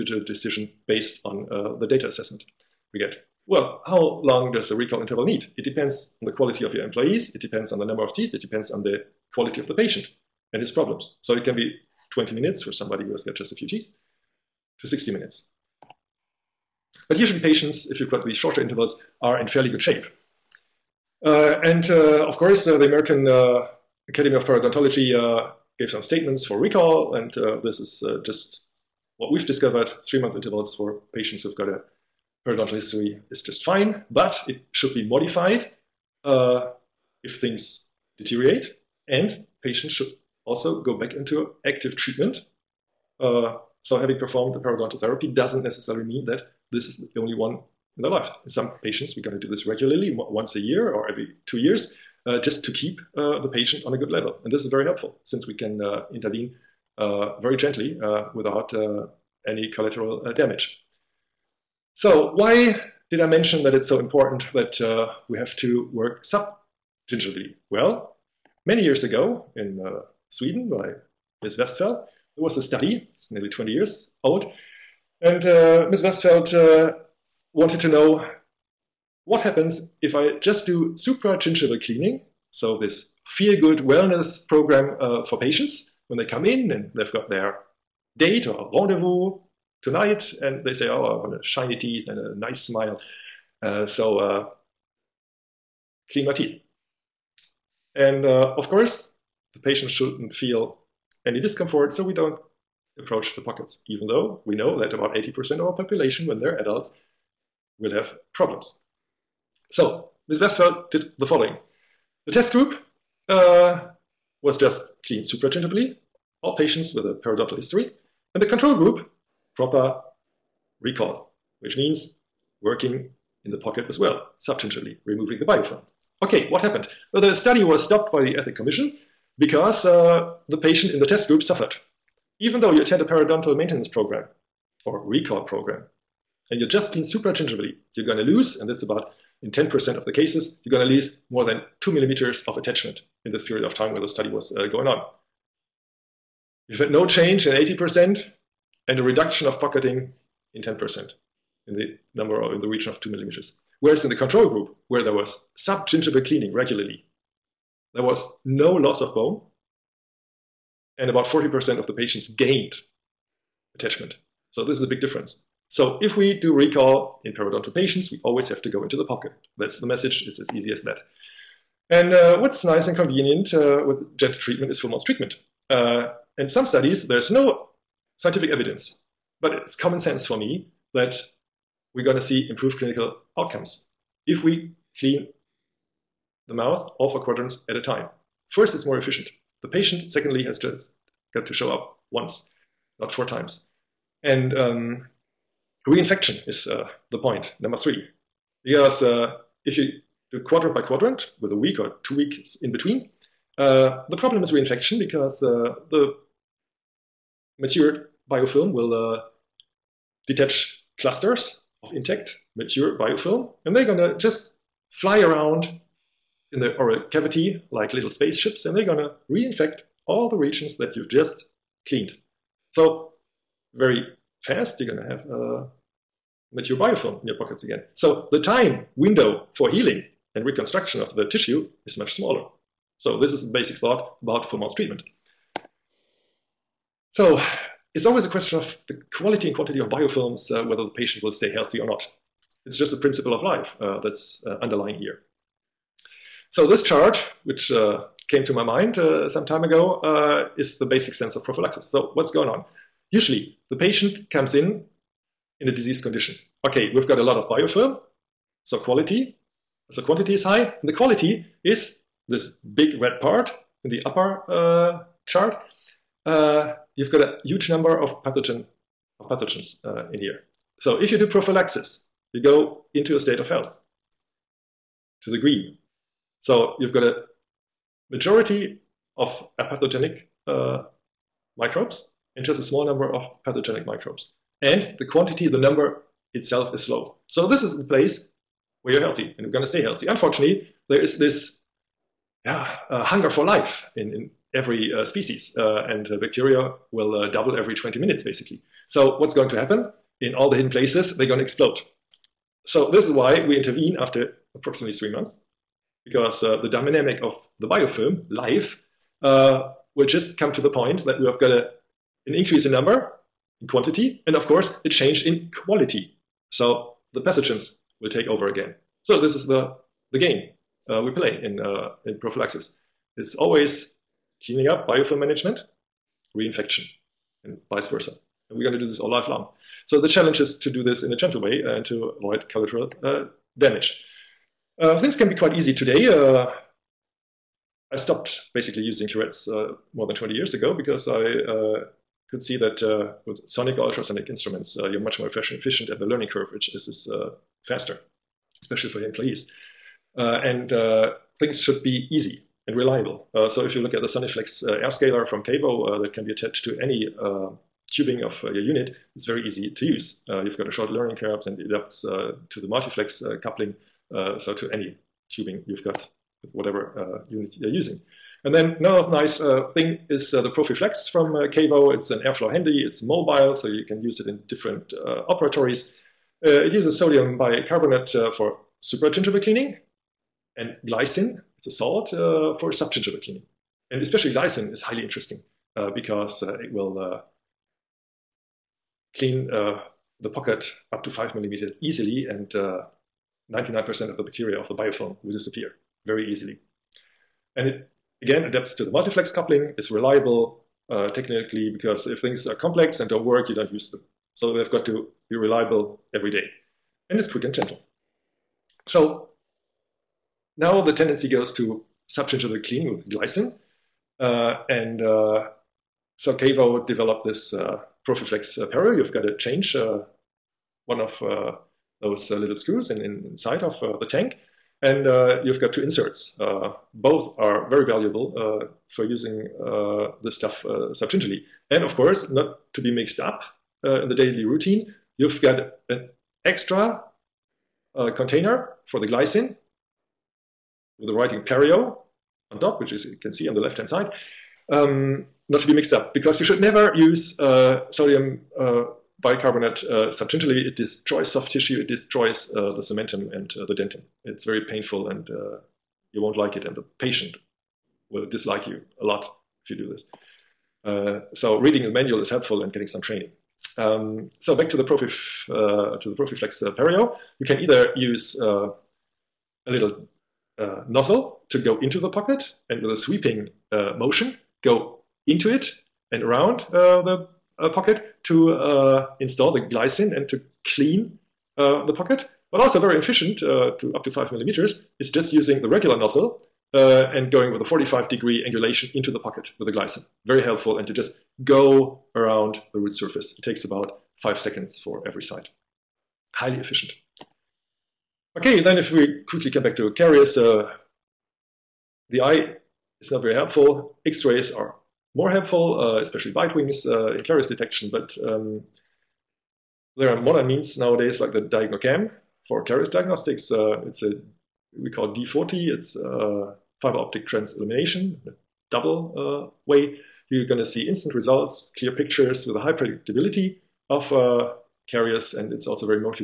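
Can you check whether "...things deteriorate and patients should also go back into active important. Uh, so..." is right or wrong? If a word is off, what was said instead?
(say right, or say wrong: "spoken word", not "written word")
wrong: "treatment", not "important".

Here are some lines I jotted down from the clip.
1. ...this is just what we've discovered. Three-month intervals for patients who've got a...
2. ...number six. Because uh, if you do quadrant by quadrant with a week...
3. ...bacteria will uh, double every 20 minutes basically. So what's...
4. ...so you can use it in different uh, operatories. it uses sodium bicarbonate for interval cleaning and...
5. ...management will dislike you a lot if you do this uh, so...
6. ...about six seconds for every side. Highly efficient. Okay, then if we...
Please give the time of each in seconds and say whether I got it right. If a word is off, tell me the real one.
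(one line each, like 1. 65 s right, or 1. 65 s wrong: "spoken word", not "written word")
1. 27 s right
2. 197 s wrong: "three", not "six"
3. 296 s right
4. 373 s wrong: "supragingival", not "interval"
5. 456 s wrong: "patient", not "management"
6. 493 s wrong: "five", not "six".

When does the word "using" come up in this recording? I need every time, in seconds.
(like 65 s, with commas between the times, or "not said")
338 s, 367 s, 429 s, 485 s.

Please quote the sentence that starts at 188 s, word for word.
First, it's more efficient the patient, secondly, has just got to show up once, not four times.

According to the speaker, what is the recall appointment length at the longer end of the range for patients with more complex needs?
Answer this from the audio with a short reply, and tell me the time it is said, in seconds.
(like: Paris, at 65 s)
60 minutes, at 14 s.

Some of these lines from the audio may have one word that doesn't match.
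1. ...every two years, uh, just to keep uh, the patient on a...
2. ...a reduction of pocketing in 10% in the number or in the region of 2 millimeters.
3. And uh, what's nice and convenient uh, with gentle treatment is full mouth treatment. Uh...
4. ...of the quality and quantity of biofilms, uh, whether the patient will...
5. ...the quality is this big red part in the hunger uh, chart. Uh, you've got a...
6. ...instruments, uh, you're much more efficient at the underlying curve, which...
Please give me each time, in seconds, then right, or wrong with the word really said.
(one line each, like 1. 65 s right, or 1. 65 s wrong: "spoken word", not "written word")
1. 51 s right
2. 148 s right
3. 171 s right
4. 238 s right
5. 260 s wrong: "upper", not "hunger"
6. 344 s wrong: "learning", not "underlying".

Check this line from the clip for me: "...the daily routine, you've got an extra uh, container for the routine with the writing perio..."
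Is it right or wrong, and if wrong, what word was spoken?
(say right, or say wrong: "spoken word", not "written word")
wrong: "glycine", not "routine".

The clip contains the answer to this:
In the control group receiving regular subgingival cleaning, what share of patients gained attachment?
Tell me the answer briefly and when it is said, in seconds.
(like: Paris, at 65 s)
40%, at 161 s.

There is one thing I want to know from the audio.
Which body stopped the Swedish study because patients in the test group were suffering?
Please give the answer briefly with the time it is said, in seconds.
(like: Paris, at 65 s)
Ethic Commission, at 128 s.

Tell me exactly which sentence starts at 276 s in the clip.
So you've got a majority of apathogenic uh, microbes and just a small number of pathogenic microbes.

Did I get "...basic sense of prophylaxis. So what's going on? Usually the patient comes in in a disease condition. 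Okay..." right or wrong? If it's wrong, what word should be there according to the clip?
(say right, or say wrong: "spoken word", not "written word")
right.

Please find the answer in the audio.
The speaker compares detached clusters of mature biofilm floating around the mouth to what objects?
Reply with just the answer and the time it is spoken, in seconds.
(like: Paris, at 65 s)
little spaceships, at 217 s.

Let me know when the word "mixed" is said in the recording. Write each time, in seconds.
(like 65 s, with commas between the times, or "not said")
432 s, 445 s.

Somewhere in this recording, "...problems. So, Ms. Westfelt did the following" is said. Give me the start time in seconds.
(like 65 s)
108 s.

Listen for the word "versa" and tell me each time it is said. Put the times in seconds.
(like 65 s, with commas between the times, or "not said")
327 s.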